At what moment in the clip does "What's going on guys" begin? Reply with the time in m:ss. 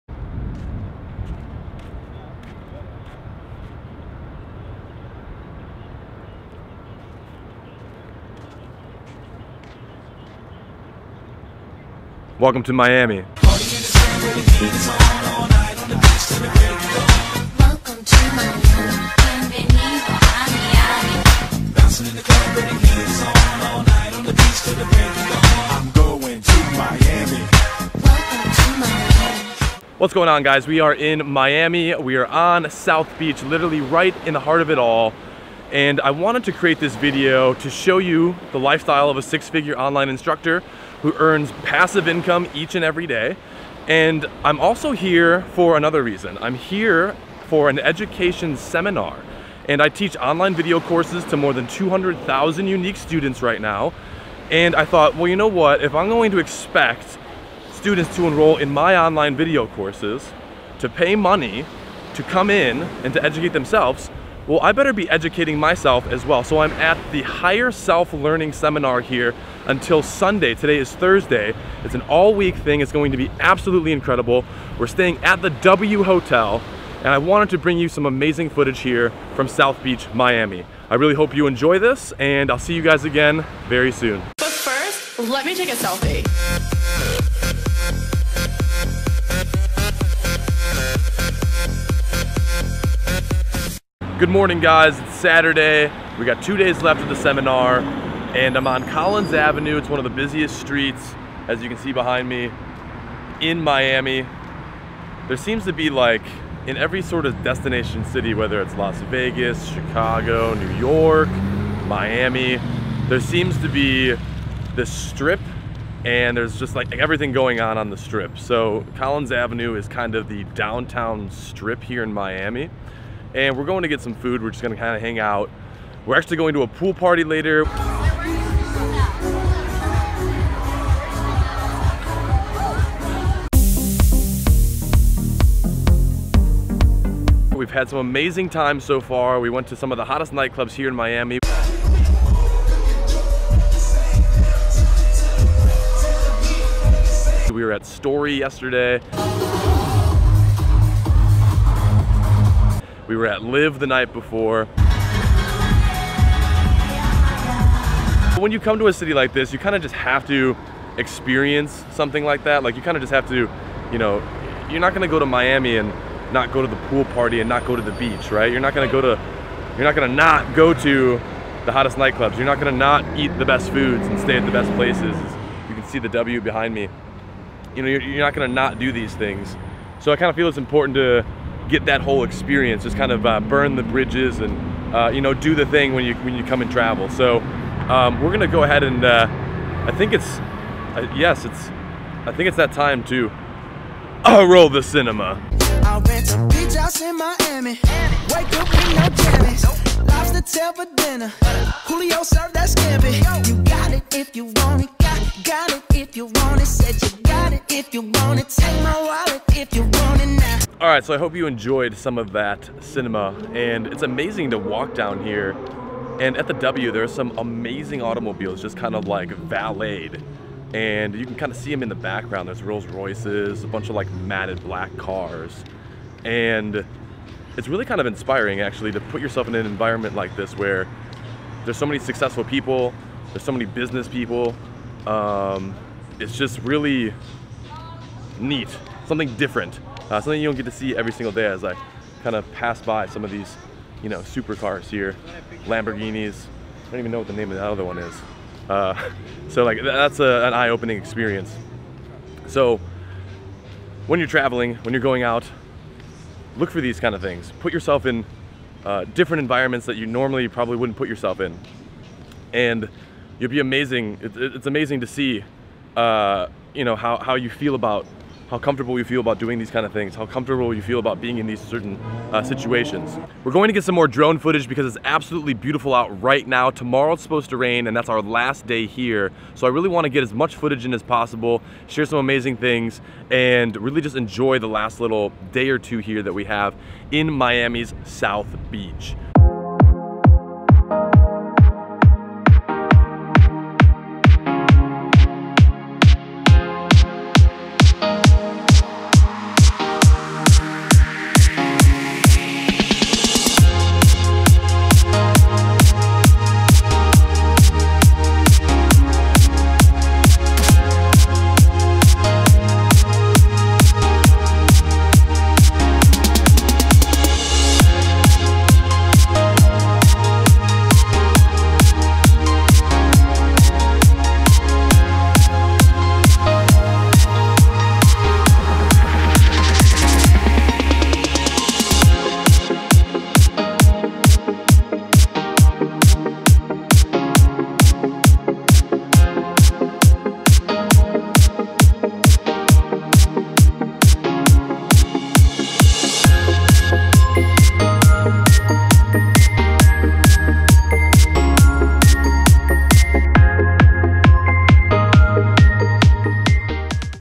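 0:29.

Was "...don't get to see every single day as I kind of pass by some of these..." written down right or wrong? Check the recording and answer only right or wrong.
right.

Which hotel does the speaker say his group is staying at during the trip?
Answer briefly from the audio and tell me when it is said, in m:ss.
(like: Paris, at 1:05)
W Hotel, at 1:15.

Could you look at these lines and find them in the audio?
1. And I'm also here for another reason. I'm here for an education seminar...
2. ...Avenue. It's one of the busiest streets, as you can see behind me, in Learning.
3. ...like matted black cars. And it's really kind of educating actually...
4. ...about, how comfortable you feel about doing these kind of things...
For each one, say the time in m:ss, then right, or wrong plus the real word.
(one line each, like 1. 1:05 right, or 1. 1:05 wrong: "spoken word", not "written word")
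1. 0:43 right
2. 1:39 wrong: "Miami", not "Learning"
3. 3:43 wrong: "inspiring", not "educating"
4. 4:27 right.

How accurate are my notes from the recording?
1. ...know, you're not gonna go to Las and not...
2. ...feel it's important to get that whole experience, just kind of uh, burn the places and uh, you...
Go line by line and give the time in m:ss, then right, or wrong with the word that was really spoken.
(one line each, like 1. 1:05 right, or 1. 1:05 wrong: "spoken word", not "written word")
1. 2:43 wrong: "Miami", not "Las"
2. 3:00 wrong: "bridges", not "places".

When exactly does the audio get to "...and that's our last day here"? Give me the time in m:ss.
4:37.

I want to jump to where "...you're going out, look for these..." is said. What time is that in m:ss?
4:14.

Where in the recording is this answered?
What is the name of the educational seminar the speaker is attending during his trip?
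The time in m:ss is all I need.
1:07.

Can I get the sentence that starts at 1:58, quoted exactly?
So Collins Avenue is kind of the downtown strip here in Miami and we're going to get some food.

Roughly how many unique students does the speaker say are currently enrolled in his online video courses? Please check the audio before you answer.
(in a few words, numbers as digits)
200,000.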